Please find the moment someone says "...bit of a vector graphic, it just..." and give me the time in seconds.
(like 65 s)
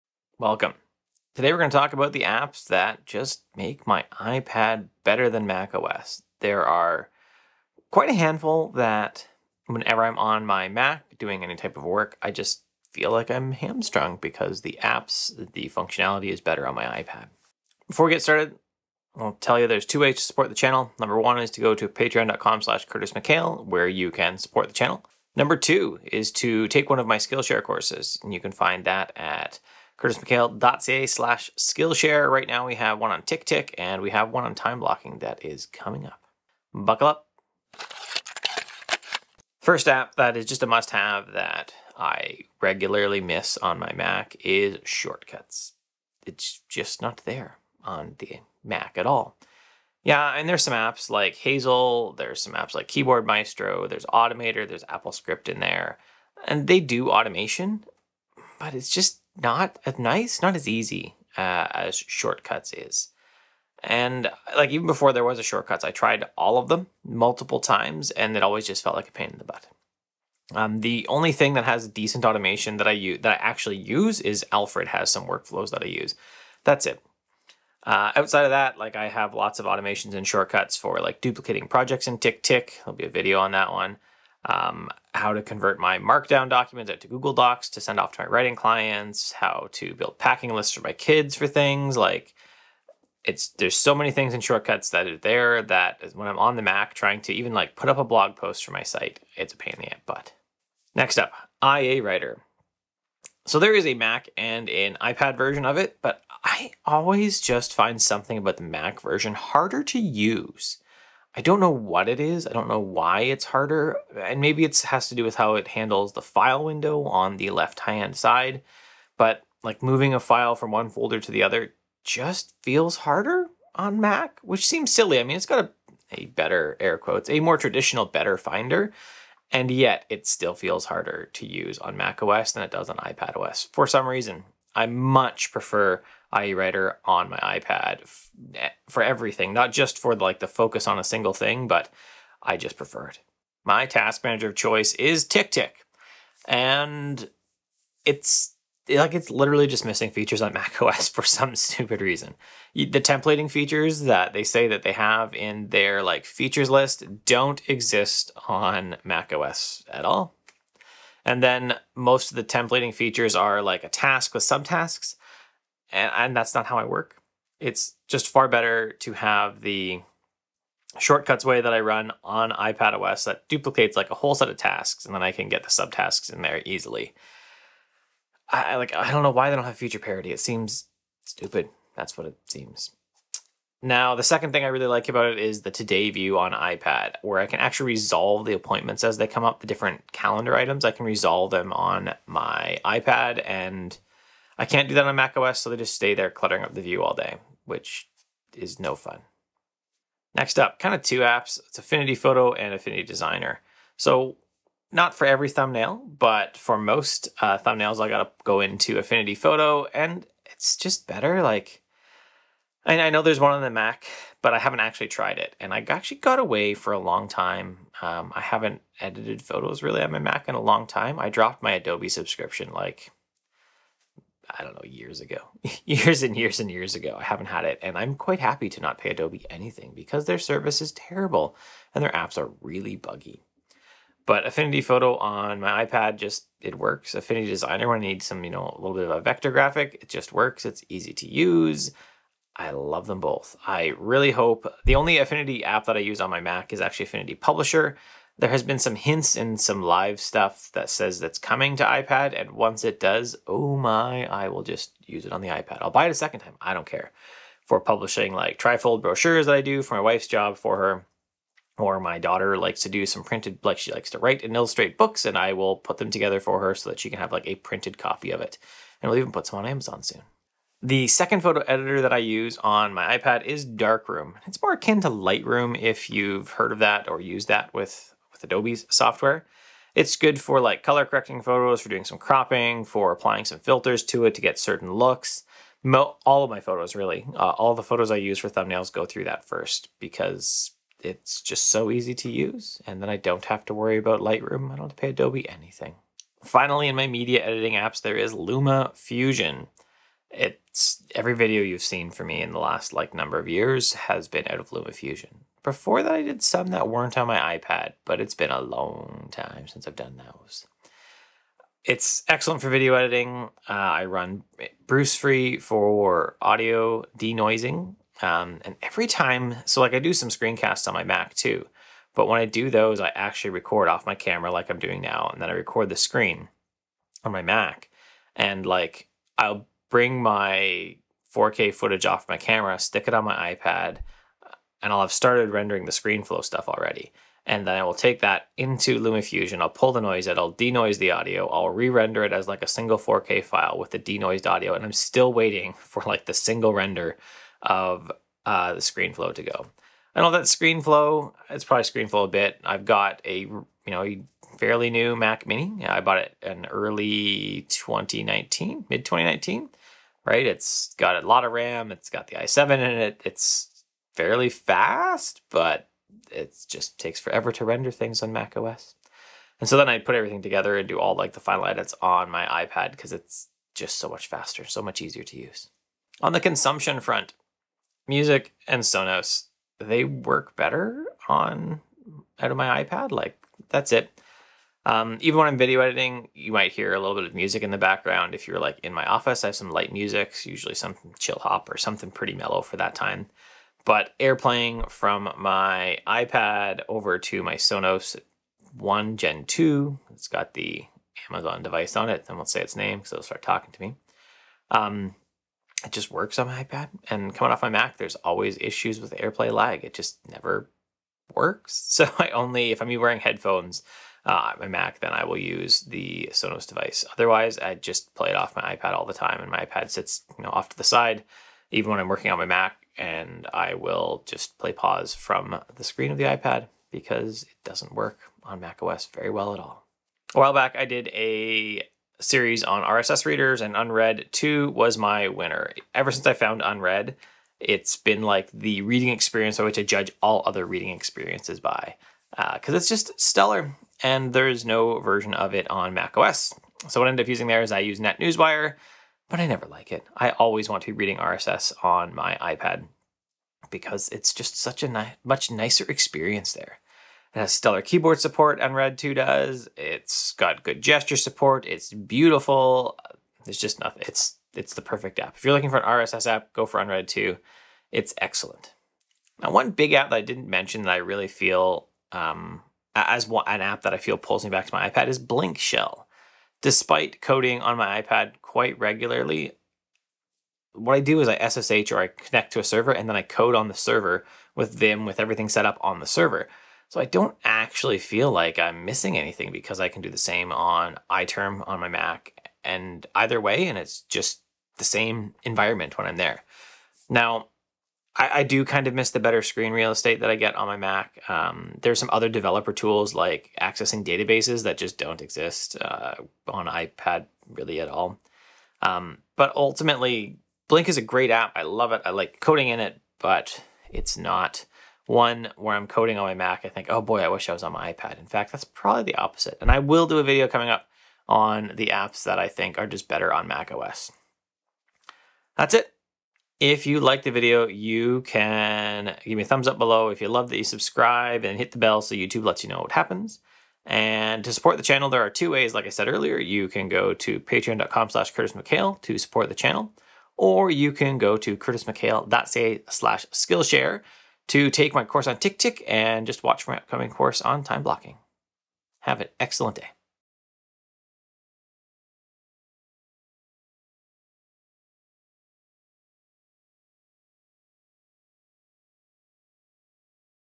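238 s.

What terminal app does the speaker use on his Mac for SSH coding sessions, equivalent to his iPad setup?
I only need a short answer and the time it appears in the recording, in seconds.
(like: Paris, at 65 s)
iTerm, at 491 s.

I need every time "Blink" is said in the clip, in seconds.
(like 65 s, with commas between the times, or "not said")
475 s, 510 s.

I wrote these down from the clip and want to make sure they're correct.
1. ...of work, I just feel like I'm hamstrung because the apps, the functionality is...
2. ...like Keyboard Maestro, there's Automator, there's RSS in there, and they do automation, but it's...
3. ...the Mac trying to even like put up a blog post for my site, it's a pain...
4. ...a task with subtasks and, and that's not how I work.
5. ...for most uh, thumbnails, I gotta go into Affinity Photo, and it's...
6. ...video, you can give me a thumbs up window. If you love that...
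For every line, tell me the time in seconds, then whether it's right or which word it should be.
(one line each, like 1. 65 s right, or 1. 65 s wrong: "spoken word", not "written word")
1. 11 s right
2. 52 s wrong: "AppleScript", not "RSS"
3. 96 s right
4. 163 s right
5. 206 s right
6. 527 s wrong: "below", not "window".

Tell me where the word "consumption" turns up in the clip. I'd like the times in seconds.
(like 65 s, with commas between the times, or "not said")
376 s.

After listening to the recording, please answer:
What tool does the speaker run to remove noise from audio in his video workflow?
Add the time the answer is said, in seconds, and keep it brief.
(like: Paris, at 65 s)
Brusfri, at 314 s.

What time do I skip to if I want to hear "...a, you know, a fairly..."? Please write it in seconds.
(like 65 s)
353 s.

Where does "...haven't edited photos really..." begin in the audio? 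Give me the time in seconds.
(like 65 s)
218 s.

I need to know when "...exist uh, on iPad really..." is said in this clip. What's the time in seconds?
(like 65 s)
505 s.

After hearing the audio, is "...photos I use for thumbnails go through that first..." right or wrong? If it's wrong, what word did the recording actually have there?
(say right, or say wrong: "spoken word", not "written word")
right.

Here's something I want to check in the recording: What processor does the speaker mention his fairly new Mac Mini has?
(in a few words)
i7.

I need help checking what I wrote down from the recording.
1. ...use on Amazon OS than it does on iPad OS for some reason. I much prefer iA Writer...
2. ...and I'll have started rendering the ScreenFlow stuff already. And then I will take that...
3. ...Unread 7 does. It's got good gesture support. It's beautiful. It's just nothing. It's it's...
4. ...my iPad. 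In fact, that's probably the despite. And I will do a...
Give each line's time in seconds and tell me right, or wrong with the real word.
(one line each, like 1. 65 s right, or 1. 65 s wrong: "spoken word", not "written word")
1. 131 s wrong: "Mac", not "Amazon"
2. 334 s right
3. 458 s wrong: "2", not "7"
4. 517 s wrong: "opposite", not "despite".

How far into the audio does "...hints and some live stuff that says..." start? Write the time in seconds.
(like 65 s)
248 s.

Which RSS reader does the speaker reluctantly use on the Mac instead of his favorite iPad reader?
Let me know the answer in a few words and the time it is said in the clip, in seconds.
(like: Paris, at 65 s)
NetNewsWire, at 447 s.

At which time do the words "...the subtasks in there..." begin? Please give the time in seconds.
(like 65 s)
175 s.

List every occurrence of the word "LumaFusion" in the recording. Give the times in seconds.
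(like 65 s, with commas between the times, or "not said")
298 s, 304 s, 338 s.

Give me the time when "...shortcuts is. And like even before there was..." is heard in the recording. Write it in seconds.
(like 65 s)
61 s.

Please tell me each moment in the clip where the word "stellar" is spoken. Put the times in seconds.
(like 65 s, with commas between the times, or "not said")
443 s, 457 s.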